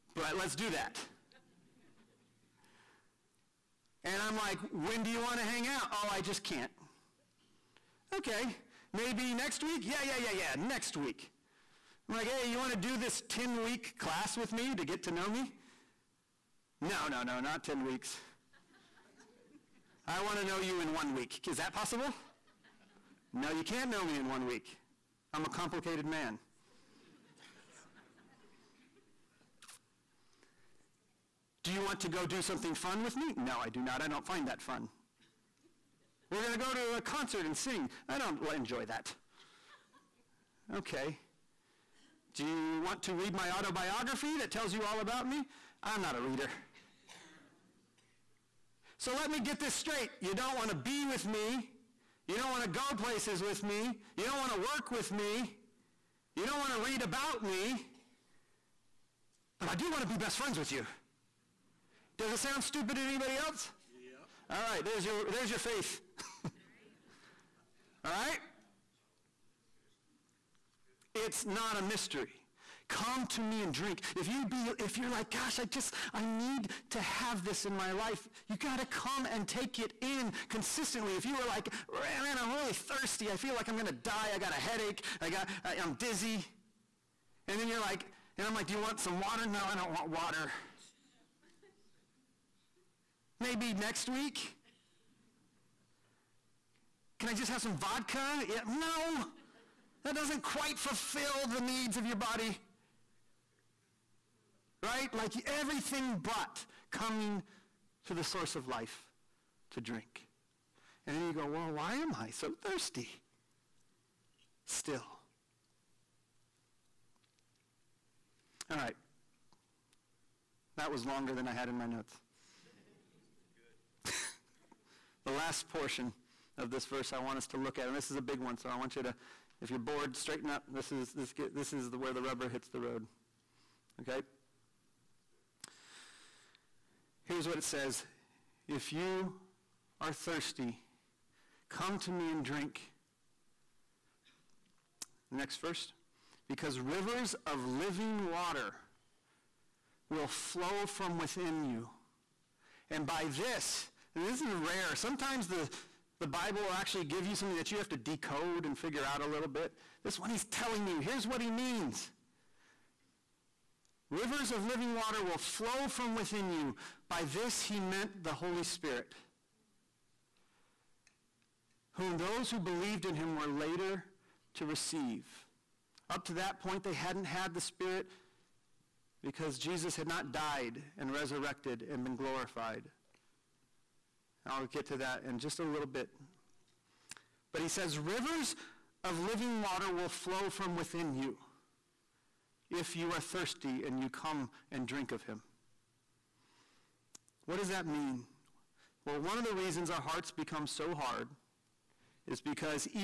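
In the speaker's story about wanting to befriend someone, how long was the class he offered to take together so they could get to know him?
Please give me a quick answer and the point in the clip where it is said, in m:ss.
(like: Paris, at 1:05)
10 weeks, at 0:13.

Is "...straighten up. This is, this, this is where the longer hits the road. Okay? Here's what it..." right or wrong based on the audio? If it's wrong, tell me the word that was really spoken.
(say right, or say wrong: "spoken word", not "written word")
wrong: "rubber", not "longer".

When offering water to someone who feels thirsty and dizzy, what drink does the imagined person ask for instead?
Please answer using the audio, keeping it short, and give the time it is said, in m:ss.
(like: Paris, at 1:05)
Vodka, at 1:37.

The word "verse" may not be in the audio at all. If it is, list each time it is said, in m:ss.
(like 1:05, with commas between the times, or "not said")
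2:06, 2:25.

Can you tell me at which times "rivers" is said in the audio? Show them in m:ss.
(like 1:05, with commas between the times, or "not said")
2:26, 2:44, 3:07.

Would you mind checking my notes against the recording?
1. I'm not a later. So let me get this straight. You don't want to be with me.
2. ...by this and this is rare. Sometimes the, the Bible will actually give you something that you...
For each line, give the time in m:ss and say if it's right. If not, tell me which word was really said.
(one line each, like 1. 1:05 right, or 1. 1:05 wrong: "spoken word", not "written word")
1. 0:45 wrong: "reader", not "later"
2. 2:33 right.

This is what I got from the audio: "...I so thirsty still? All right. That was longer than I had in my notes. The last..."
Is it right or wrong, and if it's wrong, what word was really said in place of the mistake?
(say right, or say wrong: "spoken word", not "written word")
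right.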